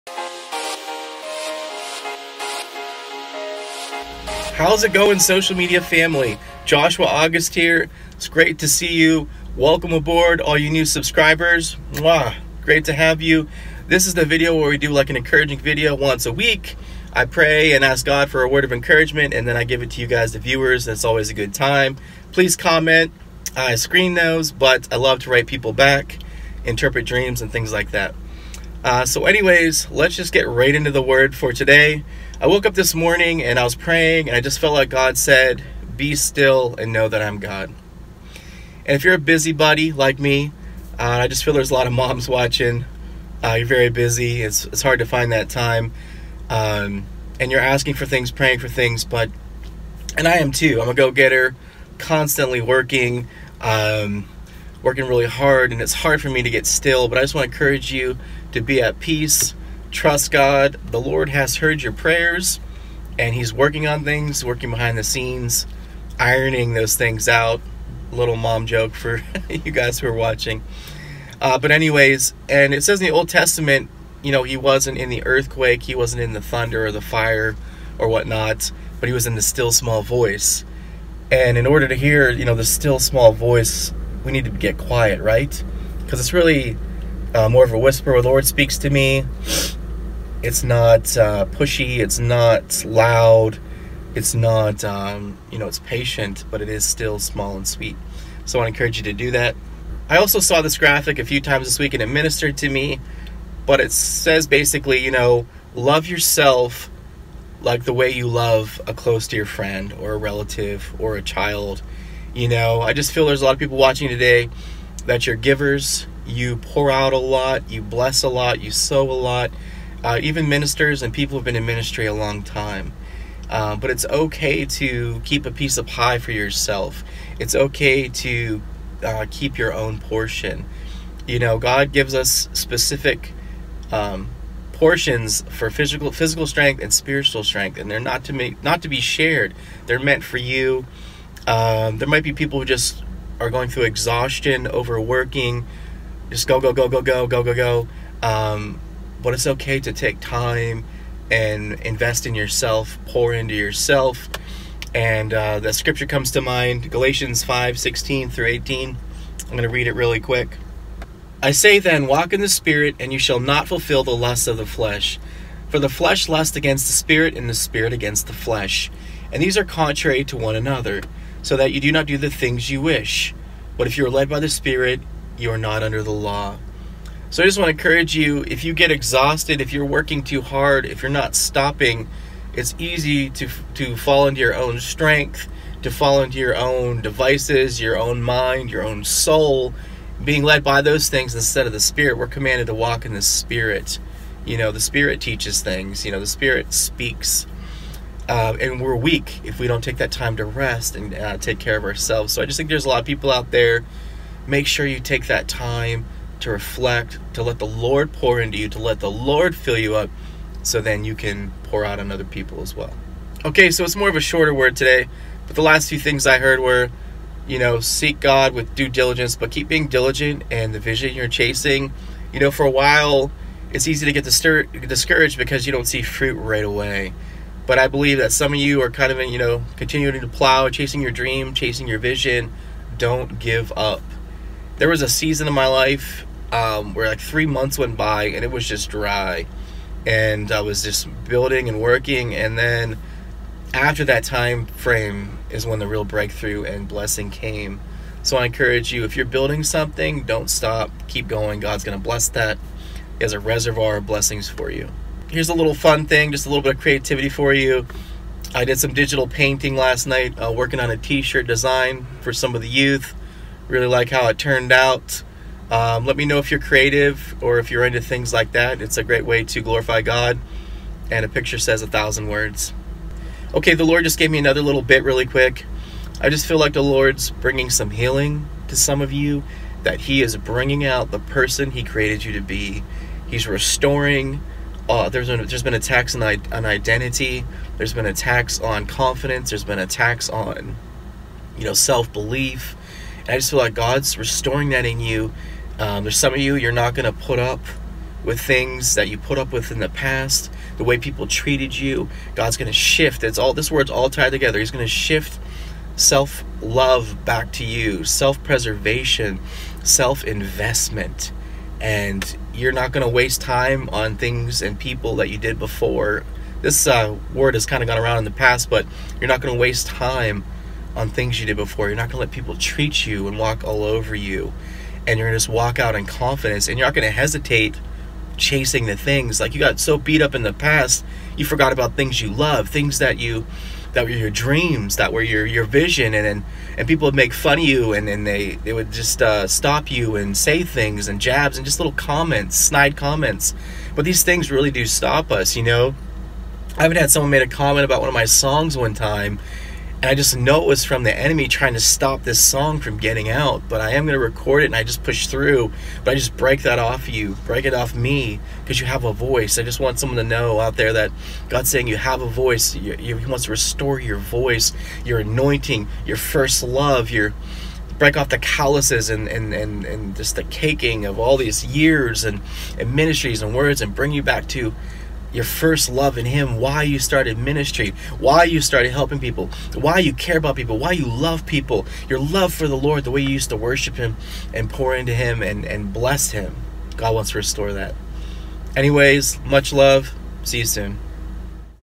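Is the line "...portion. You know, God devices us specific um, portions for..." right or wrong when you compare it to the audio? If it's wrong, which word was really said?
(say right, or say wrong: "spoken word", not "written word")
wrong: "gives", not "devices".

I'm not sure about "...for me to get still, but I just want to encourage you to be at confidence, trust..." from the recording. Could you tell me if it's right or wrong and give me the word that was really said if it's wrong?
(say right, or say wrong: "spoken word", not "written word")
wrong: "peace", not "confidence".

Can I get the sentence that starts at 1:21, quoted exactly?
And in order to hear, you know, the still small voice we need to get quiet, right?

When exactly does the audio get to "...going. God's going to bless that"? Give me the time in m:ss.
4:11.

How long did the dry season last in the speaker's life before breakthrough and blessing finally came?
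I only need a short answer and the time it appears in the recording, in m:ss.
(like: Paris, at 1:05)
3 months, at 3:57.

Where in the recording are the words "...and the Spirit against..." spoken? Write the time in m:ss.
2:47.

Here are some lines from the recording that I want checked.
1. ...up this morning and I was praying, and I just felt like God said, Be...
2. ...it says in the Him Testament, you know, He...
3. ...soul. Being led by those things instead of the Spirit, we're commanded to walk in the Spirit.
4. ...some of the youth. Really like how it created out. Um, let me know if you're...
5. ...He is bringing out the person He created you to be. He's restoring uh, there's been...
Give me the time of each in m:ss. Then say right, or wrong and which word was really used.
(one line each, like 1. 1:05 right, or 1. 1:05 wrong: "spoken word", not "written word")
1. 0:32 right
2. 1:12 wrong: "Old", not "Him"
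3. 3:09 right
4. 4:22 wrong: "turned", not "created"
5. 4:40 right.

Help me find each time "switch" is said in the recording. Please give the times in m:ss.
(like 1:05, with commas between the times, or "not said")
not said.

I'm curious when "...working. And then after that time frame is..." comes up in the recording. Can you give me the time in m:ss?
4:01.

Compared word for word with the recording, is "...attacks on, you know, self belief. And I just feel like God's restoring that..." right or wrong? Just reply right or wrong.
right.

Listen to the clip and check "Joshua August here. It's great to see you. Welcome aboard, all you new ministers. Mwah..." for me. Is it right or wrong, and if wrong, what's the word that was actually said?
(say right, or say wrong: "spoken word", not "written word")
wrong: "subscribers", not "ministers".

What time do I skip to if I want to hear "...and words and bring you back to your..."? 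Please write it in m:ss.
6:13.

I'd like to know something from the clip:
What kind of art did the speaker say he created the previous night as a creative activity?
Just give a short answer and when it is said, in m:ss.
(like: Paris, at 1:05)
digital painting, at 4:18.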